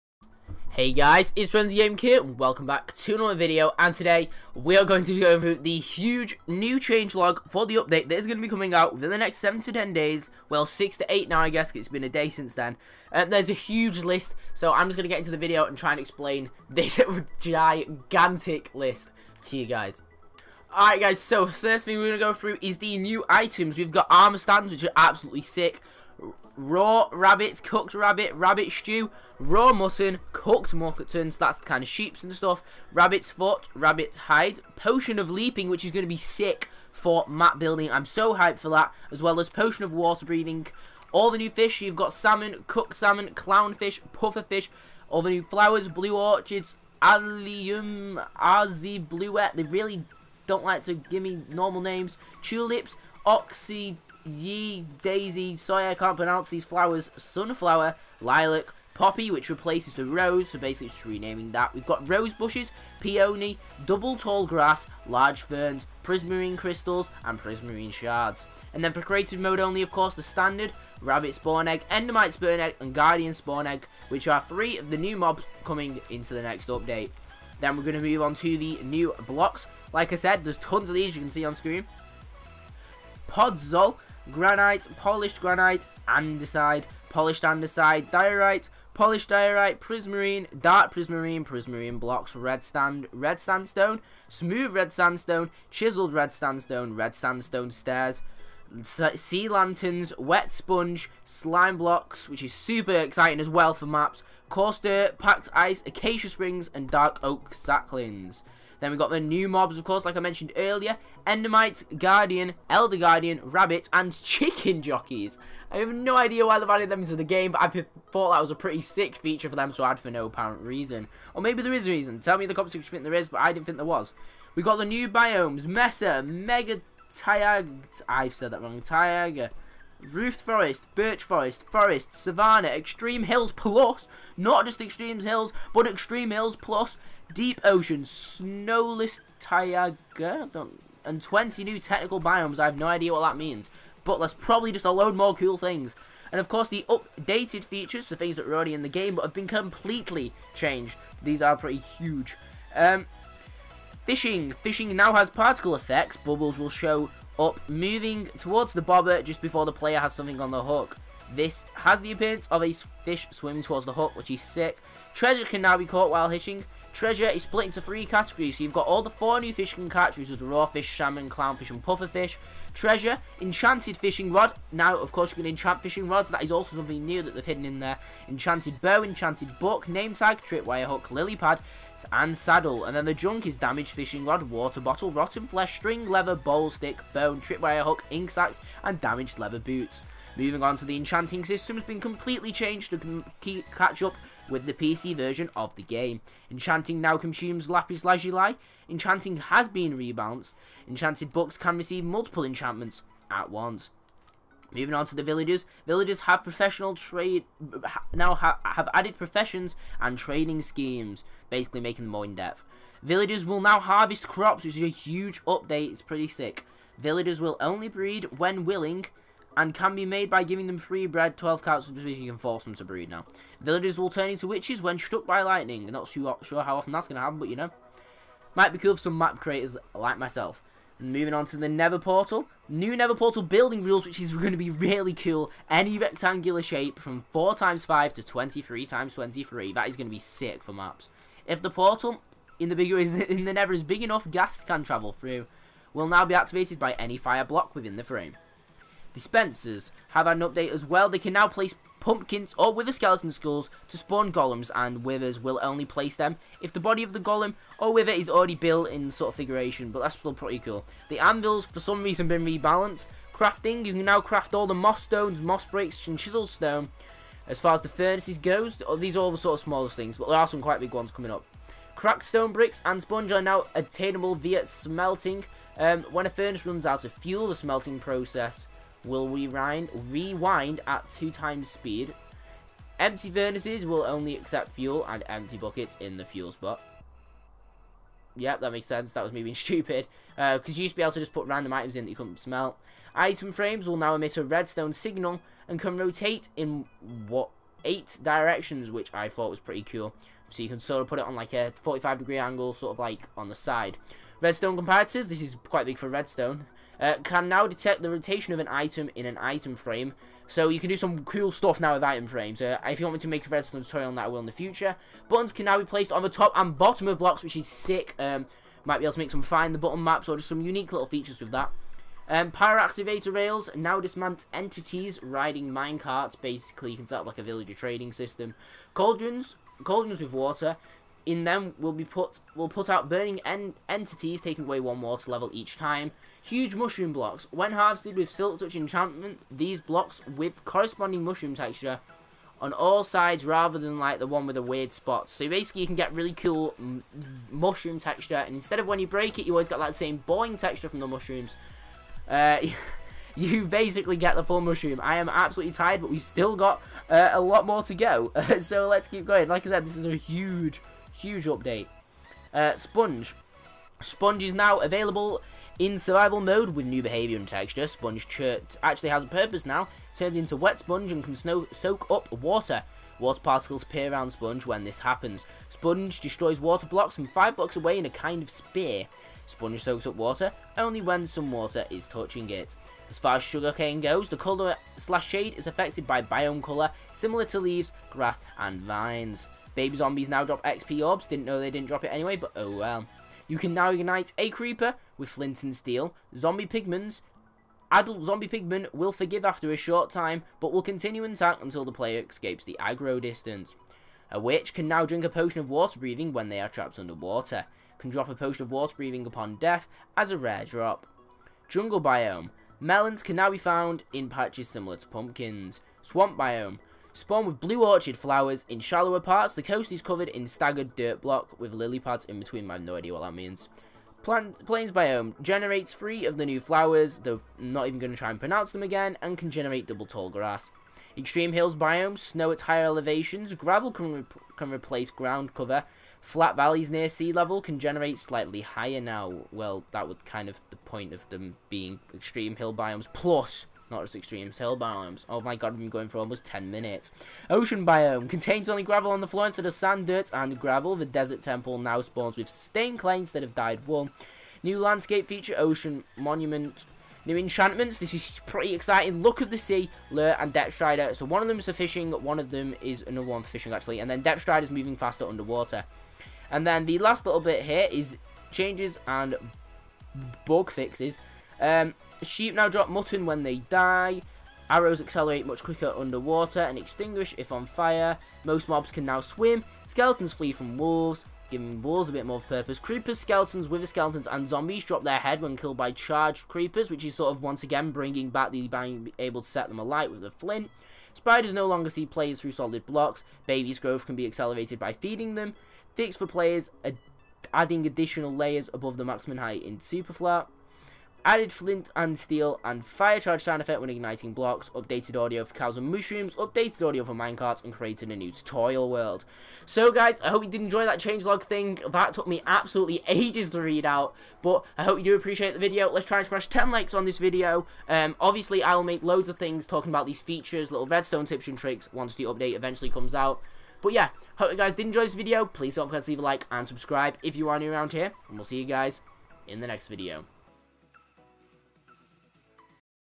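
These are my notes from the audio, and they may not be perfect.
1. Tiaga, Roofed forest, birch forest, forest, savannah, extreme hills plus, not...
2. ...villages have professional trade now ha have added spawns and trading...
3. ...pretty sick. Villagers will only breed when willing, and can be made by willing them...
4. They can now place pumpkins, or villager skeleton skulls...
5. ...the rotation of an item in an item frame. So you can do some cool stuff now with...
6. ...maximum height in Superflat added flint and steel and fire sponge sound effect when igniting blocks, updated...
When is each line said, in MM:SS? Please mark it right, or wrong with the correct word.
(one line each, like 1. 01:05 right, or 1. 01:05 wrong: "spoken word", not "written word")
1. 02:08 right
2. 03:25 wrong: "professions", not "spawns"
3. 03:36 wrong: "giving", not "willing"
4. 04:11 wrong: "wither", not "villager"
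5. 05:08 right
6. 08:19 wrong: "charge", not "sponge".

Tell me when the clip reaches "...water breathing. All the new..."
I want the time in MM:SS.
00:39.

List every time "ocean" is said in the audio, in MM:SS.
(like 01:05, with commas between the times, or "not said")
02:17, 07:27, 07:35.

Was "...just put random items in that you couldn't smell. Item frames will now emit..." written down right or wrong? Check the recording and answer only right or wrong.
right.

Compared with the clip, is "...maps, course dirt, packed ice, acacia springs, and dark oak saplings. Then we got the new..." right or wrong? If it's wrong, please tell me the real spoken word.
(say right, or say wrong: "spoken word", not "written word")
wrong: "coarse", not "course".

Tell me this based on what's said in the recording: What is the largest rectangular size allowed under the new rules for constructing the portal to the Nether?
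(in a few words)
23 times 23.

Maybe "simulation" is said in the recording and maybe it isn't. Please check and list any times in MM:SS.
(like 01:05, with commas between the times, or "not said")
not said.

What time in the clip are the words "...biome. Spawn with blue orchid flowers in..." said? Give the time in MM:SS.
06:56.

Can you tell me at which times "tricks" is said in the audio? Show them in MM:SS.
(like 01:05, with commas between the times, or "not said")
08:41.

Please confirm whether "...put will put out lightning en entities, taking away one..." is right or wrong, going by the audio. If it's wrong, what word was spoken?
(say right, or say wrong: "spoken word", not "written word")
wrong: "burning", not "lightning".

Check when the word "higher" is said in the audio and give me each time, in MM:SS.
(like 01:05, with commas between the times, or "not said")
07:12, 07:18.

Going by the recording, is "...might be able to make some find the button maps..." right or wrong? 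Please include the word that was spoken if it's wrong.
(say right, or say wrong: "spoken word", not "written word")
right.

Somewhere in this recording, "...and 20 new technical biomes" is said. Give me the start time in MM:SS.
02:21.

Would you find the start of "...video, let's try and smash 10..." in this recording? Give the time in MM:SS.
08:35.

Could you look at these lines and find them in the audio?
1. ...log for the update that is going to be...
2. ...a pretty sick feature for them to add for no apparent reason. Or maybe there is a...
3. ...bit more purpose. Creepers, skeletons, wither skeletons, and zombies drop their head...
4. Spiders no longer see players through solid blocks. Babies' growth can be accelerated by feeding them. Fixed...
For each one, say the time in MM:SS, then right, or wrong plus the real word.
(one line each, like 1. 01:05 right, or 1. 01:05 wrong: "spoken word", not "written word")
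1. 00:07 right
2. 01:58 right
3. 08:02 right
4. 08:11 right.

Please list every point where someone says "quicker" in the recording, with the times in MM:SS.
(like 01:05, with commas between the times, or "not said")
07:55.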